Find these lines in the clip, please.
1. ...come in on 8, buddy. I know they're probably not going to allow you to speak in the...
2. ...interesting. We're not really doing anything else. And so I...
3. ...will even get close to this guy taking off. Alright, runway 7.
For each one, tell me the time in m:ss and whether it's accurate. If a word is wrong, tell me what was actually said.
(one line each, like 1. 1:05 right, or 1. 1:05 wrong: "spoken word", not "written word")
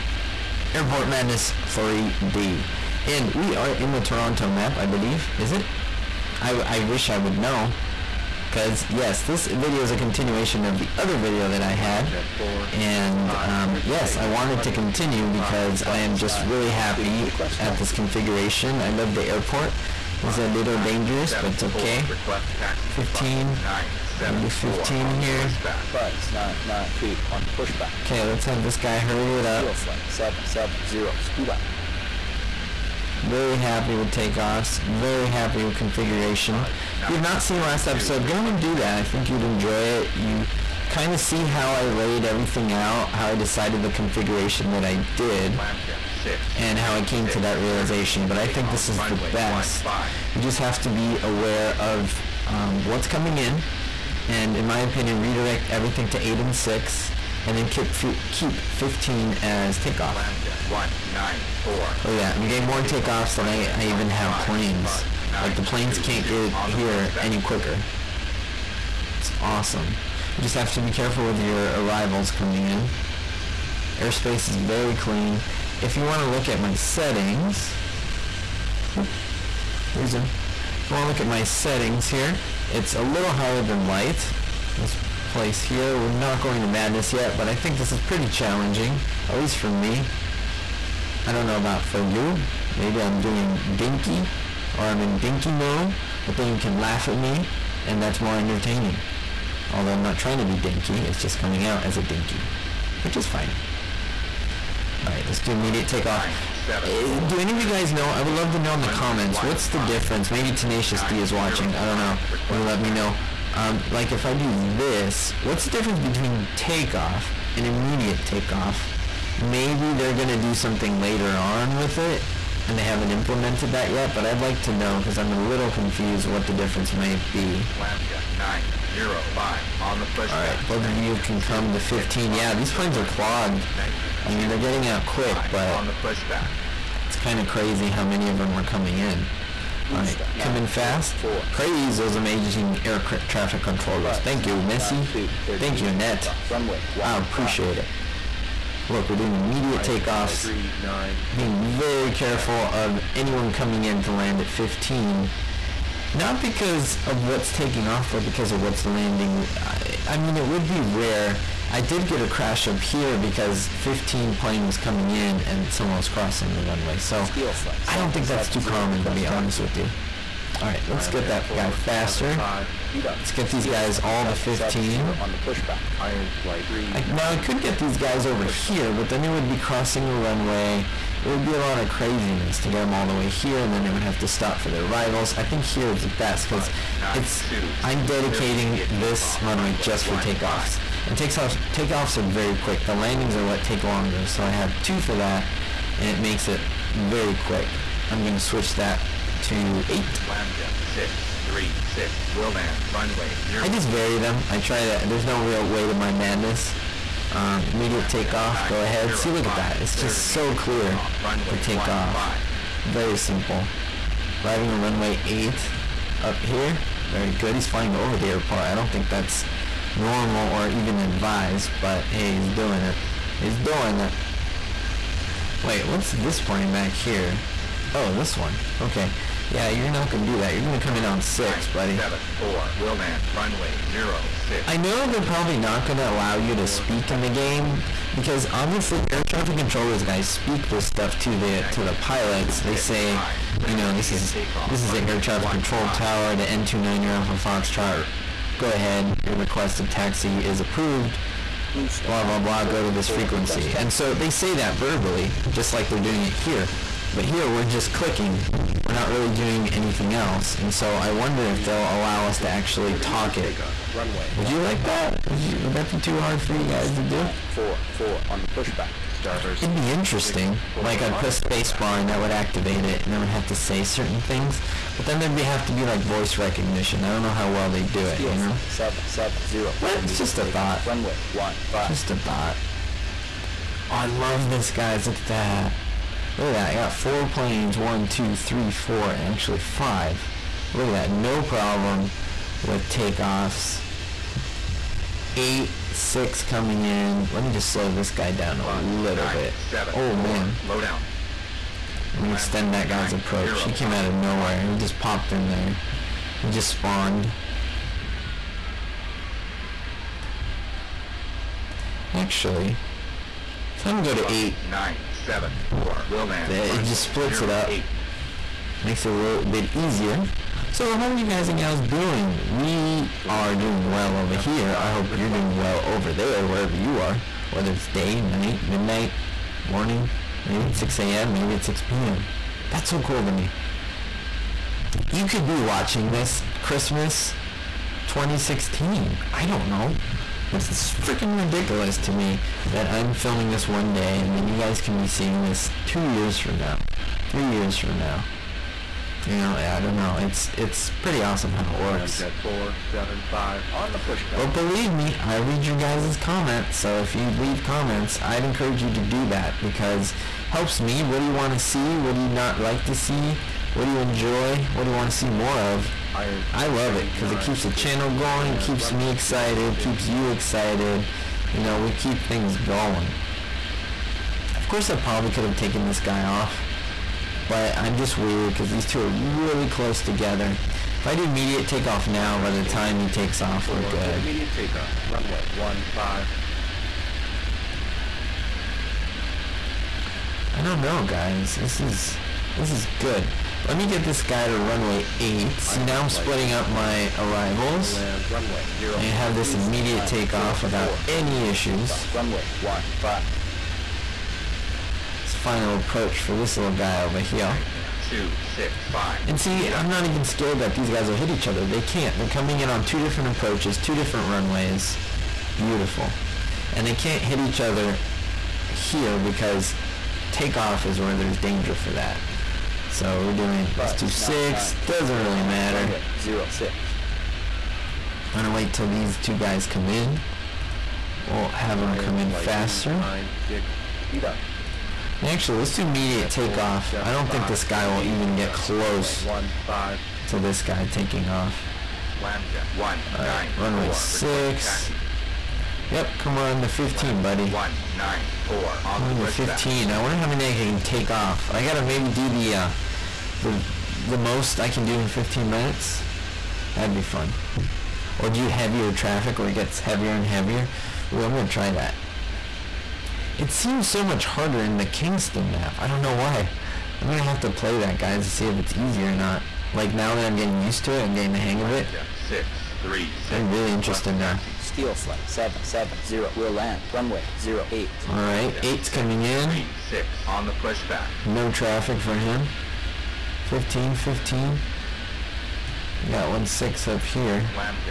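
1. 3:50 wrong: "6", not "8"
2. 4:17 wrong: "clicking", not "interesting"
3. 7:17 wrong: "6", not "7".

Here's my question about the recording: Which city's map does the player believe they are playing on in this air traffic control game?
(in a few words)
Toronto.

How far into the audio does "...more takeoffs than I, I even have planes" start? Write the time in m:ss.
1:02.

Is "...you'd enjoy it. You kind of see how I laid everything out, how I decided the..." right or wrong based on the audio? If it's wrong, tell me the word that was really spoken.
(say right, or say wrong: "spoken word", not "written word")
right.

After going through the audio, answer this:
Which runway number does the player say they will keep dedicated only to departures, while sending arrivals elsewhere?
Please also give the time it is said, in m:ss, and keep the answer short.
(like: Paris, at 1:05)
15, at 0:58.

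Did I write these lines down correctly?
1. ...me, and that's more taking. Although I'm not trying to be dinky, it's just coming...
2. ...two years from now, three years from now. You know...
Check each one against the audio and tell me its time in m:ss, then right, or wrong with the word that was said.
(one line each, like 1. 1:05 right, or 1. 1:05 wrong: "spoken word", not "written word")
1. 1:37 wrong: "entertaining", not "taking"
2. 5:45 right.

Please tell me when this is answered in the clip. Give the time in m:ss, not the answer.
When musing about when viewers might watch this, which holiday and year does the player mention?
5:36.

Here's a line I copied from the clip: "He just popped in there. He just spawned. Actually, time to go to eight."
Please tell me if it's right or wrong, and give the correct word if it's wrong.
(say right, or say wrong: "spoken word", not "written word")
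right.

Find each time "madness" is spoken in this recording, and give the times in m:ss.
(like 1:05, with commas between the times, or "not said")
0:01, 1:26, 3:26.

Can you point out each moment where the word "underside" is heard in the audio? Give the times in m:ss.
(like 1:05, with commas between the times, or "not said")
not said.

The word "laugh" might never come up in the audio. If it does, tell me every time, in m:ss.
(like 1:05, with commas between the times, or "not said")
1:36.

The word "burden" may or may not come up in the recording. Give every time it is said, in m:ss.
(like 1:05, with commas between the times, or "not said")
not said.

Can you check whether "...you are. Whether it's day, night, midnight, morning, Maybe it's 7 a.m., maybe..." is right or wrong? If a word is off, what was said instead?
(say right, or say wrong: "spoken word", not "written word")
wrong: "6", not "7".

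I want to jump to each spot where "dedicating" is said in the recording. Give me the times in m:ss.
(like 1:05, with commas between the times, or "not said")
3:08.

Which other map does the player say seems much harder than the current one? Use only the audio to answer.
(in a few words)
Kingston.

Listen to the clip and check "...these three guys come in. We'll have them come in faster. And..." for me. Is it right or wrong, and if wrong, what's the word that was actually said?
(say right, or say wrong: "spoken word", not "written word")
wrong: "two", not "three".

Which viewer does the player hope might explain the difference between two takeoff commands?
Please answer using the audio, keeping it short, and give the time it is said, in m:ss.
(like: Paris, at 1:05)
Tenacious D, at 1:50.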